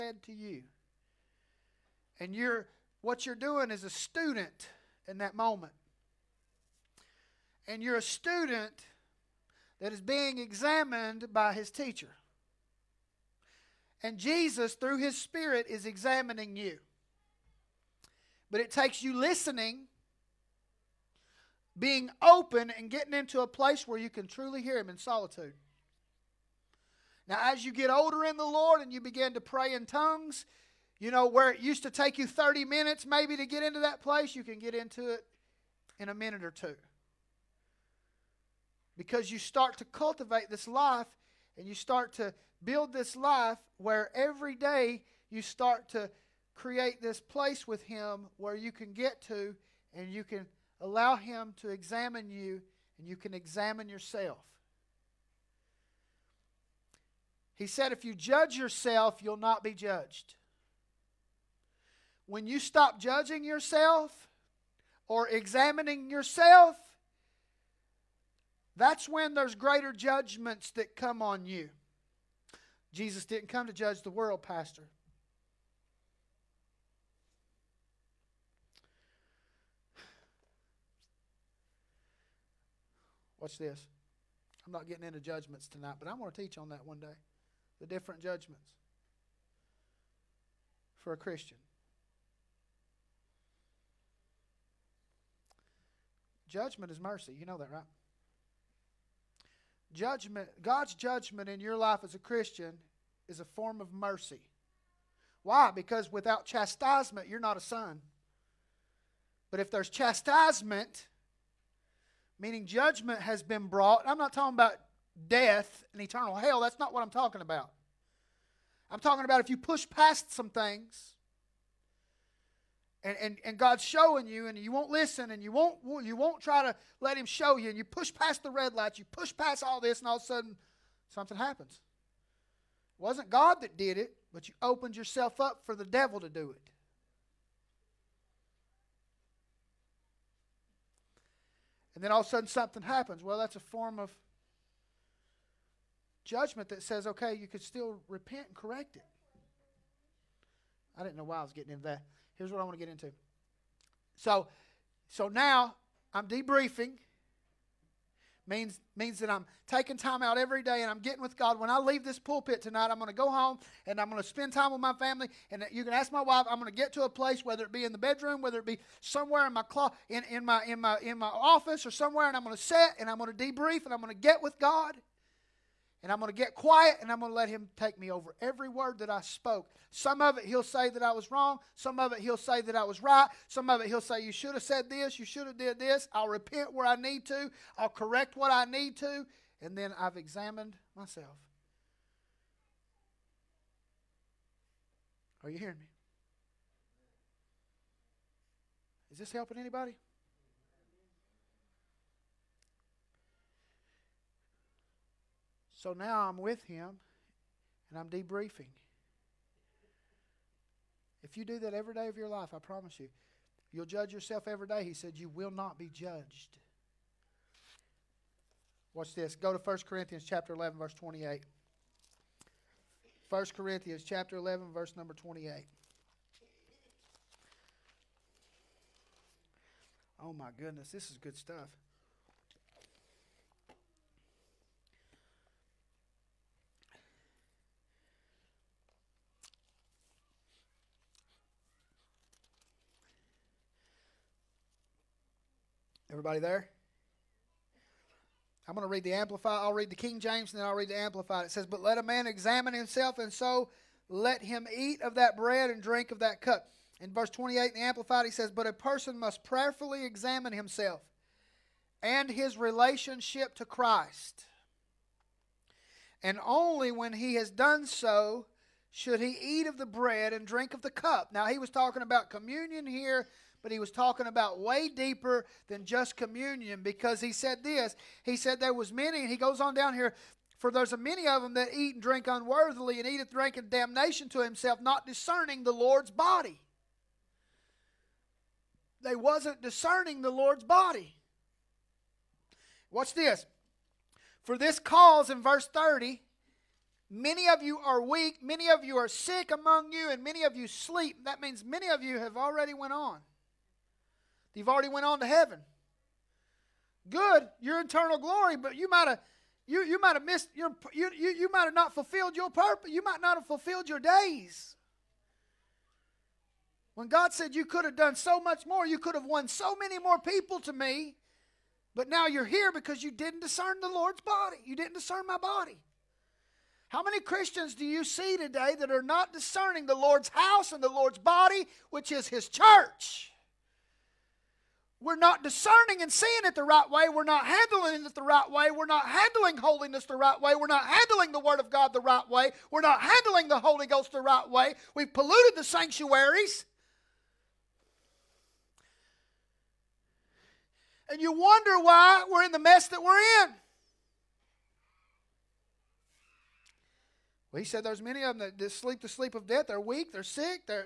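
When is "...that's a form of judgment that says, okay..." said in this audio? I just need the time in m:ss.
2:23.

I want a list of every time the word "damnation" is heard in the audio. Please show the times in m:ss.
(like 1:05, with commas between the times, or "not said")
4:43.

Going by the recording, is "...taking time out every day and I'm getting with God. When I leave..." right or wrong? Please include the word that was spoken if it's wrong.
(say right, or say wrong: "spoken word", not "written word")
right.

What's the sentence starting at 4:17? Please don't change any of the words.
In verse 28 in the Amplified, he says, But a person must prayerfully examine himself and his relationship to Christ.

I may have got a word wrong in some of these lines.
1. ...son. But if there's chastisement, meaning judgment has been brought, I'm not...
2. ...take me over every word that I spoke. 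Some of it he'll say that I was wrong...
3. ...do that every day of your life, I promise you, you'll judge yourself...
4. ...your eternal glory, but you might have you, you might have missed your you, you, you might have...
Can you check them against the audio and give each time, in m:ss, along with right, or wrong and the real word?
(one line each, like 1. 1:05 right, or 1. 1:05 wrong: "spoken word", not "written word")
1. 1:47 right
2. 2:57 right
3. 3:31 right
4. 5:07 right.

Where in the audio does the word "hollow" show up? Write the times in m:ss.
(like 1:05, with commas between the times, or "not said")
not said.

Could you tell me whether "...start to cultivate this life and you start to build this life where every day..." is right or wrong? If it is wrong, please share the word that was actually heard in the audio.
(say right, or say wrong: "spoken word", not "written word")
right.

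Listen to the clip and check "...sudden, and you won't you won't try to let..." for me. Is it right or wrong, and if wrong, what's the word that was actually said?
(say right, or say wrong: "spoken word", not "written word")
wrong: "listen", not "sudden".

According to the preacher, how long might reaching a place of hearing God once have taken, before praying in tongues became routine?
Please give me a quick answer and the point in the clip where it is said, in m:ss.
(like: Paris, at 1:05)
30 minutes, at 0:32.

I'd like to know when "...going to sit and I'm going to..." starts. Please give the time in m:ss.
2:52.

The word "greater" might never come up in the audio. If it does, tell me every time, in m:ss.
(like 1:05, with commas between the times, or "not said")
1:09.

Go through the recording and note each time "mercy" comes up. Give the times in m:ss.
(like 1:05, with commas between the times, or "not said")
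1:37, 1:43.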